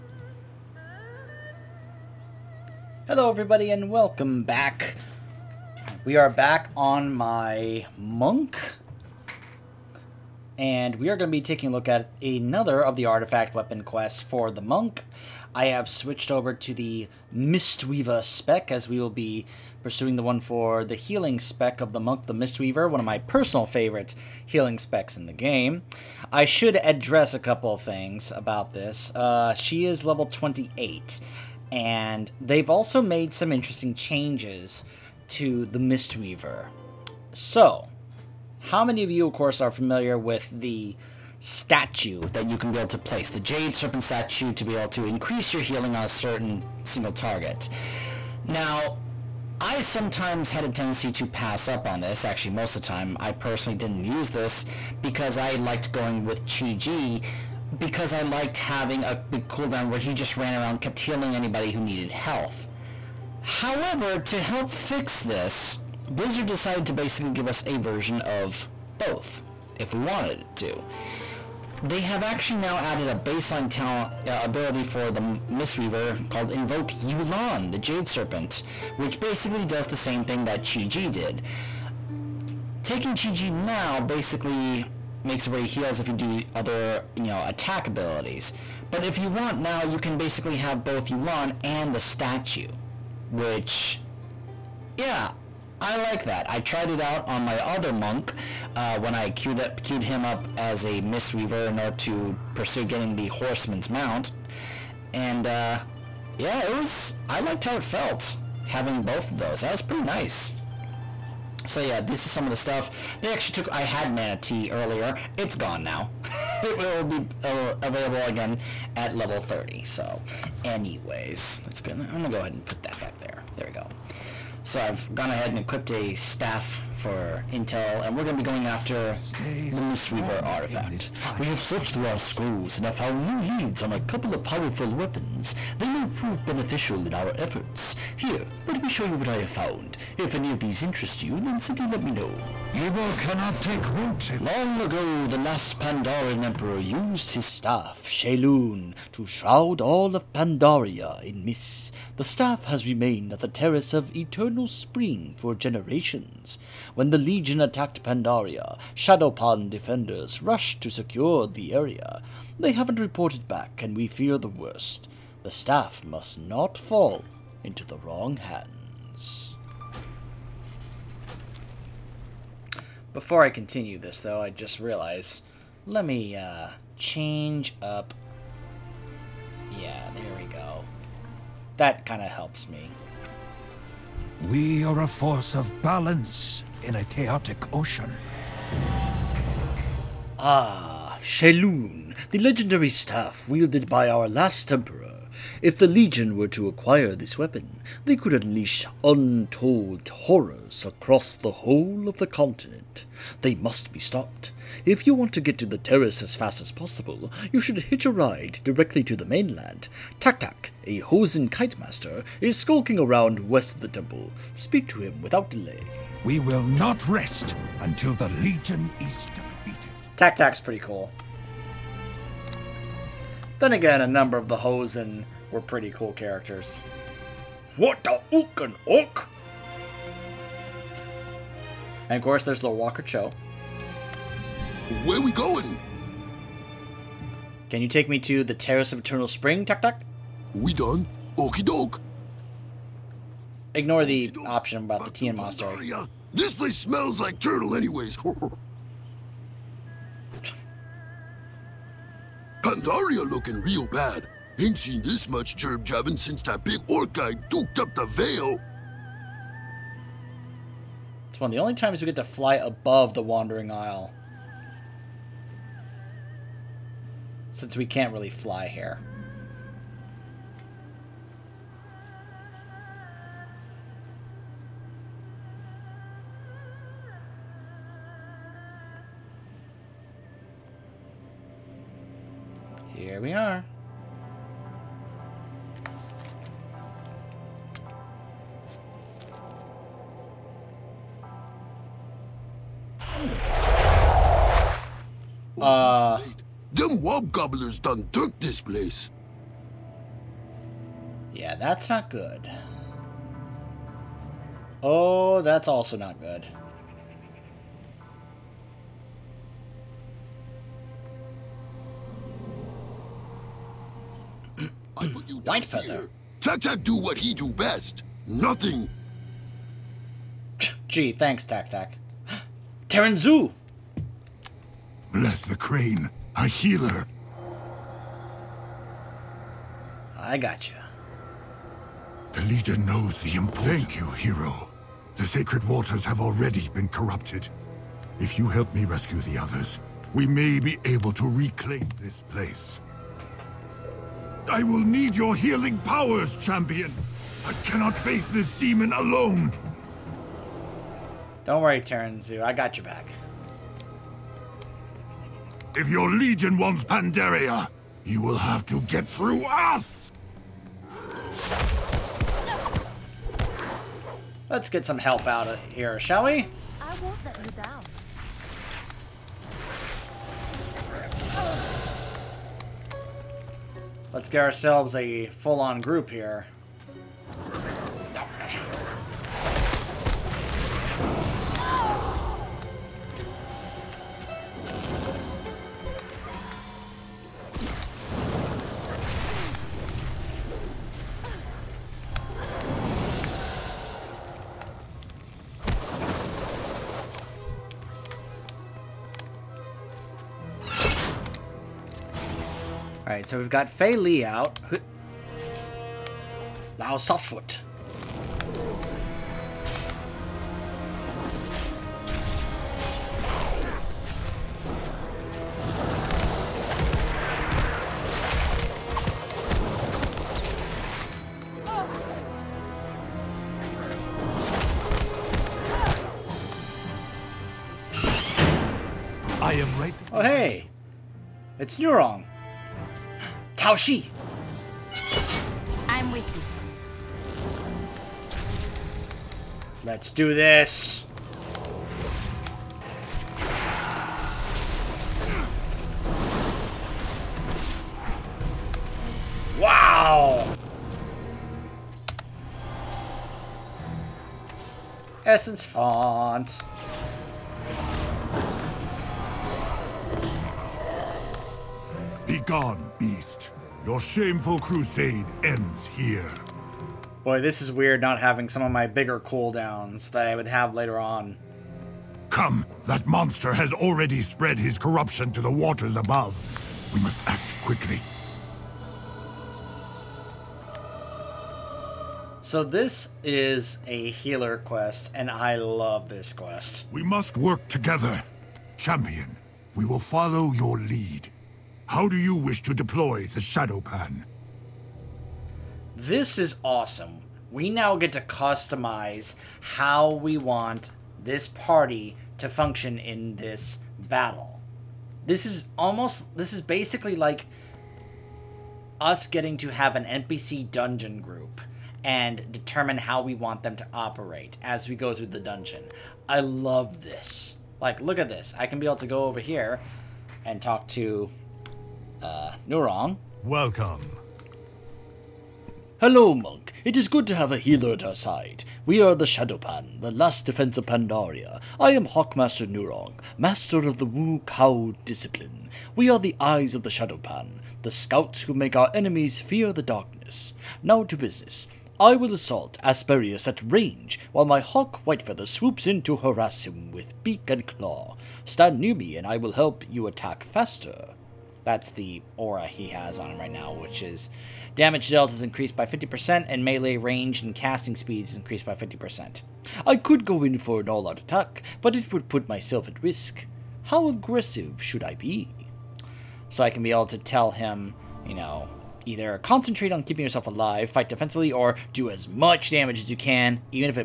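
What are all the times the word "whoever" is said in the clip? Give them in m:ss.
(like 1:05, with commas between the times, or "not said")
not said.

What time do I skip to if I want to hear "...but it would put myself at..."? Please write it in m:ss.
9:21.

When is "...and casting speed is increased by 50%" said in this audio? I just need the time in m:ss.
9:17.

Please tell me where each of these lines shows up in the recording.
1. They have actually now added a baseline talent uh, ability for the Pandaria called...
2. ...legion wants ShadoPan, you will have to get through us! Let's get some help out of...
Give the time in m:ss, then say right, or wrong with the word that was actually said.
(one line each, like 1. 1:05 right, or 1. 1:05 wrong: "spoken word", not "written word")
1. 1:11 wrong: "Mistweaver", not "Pandaria"
2. 5:56 wrong: "Pandaria", not "ShadoPan".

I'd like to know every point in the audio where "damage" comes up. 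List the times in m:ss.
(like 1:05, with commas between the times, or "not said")
9:14, 9:32.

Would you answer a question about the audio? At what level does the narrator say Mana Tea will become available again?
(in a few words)
30.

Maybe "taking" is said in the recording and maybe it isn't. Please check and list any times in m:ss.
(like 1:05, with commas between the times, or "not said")
0:11, 1:22.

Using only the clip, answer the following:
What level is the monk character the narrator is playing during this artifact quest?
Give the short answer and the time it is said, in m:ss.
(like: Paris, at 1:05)
28, at 0:30.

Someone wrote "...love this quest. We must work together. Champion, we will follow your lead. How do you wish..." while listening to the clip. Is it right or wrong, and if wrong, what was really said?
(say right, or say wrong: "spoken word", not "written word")
right.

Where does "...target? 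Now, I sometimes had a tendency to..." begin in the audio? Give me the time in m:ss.
0:47.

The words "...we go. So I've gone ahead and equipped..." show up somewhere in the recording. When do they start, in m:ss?
2:03.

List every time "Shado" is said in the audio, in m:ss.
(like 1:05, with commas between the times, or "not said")
2:38, 8:13, 8:49, 8:56.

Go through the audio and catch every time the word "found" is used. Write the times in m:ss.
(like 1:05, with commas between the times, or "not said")
2:12, 2:19.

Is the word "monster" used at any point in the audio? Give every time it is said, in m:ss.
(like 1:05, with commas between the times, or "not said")
4:05, 7:53.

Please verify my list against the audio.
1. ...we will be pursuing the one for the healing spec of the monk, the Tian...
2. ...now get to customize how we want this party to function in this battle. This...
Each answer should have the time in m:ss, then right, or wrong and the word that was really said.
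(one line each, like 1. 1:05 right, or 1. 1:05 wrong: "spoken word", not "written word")
1. 0:18 wrong: "Mistweaver", not "Tian"
2. 8:17 right.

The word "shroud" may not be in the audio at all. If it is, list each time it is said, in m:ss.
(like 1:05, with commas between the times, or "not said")
2:29.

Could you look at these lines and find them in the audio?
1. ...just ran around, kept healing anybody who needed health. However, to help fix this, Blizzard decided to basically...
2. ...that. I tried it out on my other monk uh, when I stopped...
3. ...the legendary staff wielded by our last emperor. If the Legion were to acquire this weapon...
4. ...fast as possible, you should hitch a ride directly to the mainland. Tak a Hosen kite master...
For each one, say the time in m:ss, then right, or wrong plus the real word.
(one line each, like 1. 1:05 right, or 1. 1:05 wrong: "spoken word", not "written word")
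1. 1:00 right
2. 1:36 wrong: "queued", not "stopped"
3. 3:12 right
4. 3:26 right.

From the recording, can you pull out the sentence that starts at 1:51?
So yeah, this is some of the stuff.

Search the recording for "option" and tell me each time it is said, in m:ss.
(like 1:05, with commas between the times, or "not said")
4:04.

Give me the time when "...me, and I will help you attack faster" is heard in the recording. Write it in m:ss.
9:08.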